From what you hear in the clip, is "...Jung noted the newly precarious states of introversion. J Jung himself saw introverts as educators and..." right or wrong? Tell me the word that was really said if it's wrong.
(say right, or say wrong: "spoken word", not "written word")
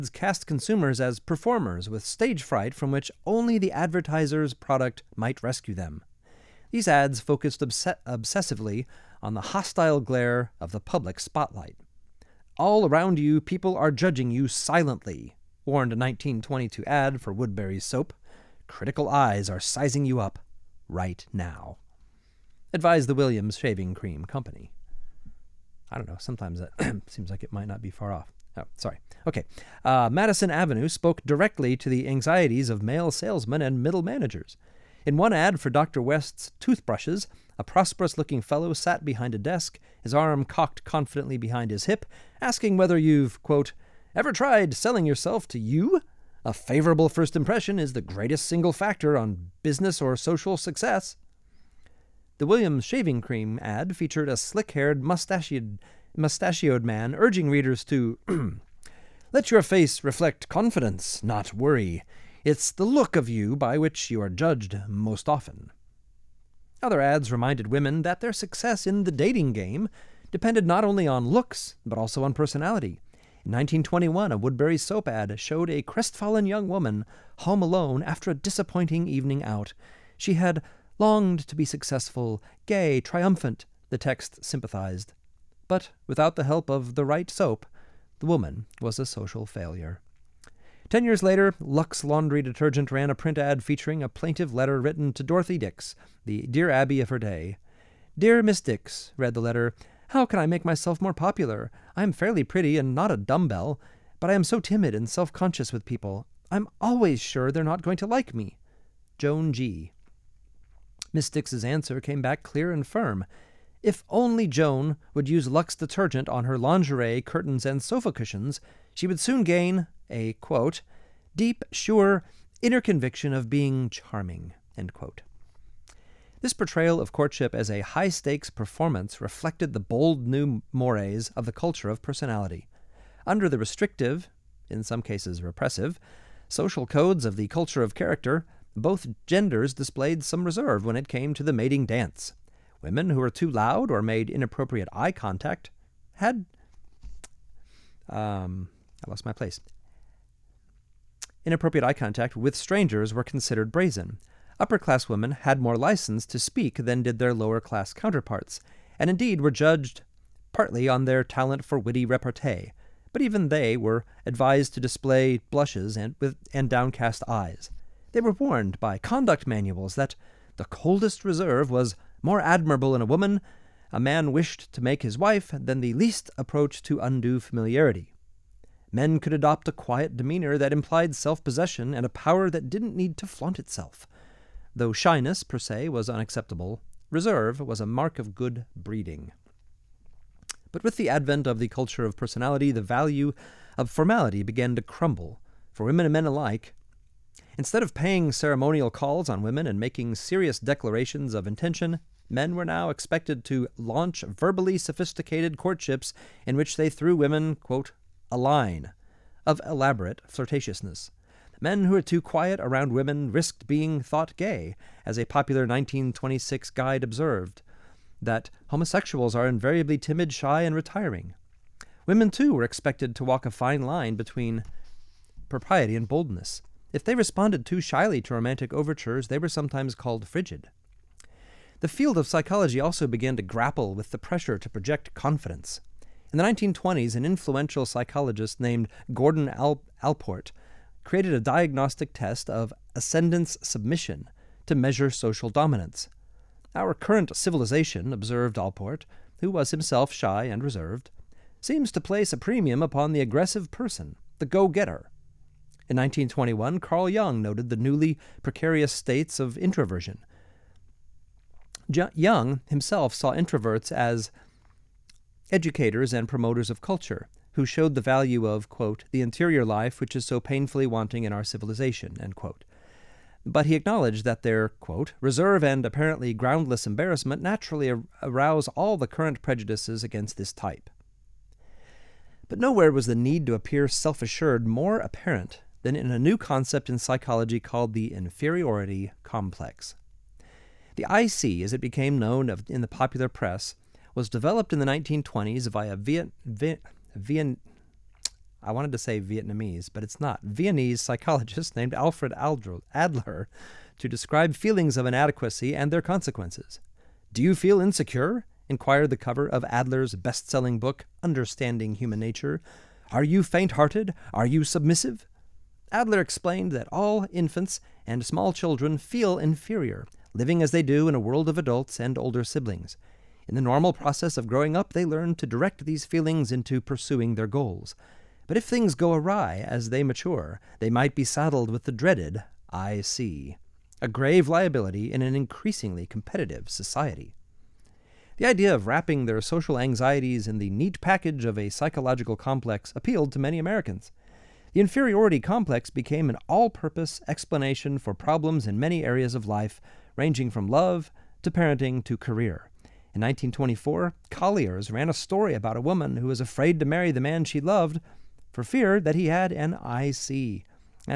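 right.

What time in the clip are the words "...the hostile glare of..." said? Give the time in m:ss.
0:09.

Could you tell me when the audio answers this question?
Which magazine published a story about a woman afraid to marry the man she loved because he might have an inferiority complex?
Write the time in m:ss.
5:54.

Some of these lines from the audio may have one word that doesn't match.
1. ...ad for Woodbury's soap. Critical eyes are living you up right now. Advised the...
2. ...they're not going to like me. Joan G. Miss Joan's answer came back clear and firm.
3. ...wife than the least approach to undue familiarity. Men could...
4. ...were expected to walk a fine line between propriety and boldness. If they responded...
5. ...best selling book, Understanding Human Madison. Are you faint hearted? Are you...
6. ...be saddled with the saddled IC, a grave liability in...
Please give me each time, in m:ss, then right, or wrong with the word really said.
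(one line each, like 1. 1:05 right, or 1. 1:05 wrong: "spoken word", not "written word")
1. 0:16 wrong: "sizing", not "living"
2. 1:47 wrong: "Dix", not "Joan"
3. 2:55 right
4. 3:42 right
5. 5:10 wrong: "Nature", not "Madison"
6. 5:31 wrong: "dreaded", not "saddled".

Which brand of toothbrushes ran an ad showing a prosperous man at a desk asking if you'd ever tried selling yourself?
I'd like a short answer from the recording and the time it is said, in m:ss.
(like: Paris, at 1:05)
Dr. West's, at 0:35.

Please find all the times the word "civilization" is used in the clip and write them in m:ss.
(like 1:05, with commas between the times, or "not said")
4:07, 4:31.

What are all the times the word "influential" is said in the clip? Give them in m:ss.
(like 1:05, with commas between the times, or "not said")
3:57.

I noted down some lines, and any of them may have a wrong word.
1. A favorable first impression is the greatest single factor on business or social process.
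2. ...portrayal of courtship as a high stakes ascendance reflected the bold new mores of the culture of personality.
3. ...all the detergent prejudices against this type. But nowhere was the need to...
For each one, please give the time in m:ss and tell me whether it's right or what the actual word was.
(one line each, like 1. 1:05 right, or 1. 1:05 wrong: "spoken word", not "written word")
1. 0:46 wrong: "success", not "process"
2. 2:06 wrong: "performance", not "ascendance"
3. 4:38 wrong: "current", not "detergent".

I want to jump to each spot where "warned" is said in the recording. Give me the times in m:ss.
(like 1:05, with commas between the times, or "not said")
0:15, 2:48.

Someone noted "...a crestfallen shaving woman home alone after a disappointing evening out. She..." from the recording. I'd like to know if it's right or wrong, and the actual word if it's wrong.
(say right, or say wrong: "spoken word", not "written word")
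wrong: "young", not "shaving".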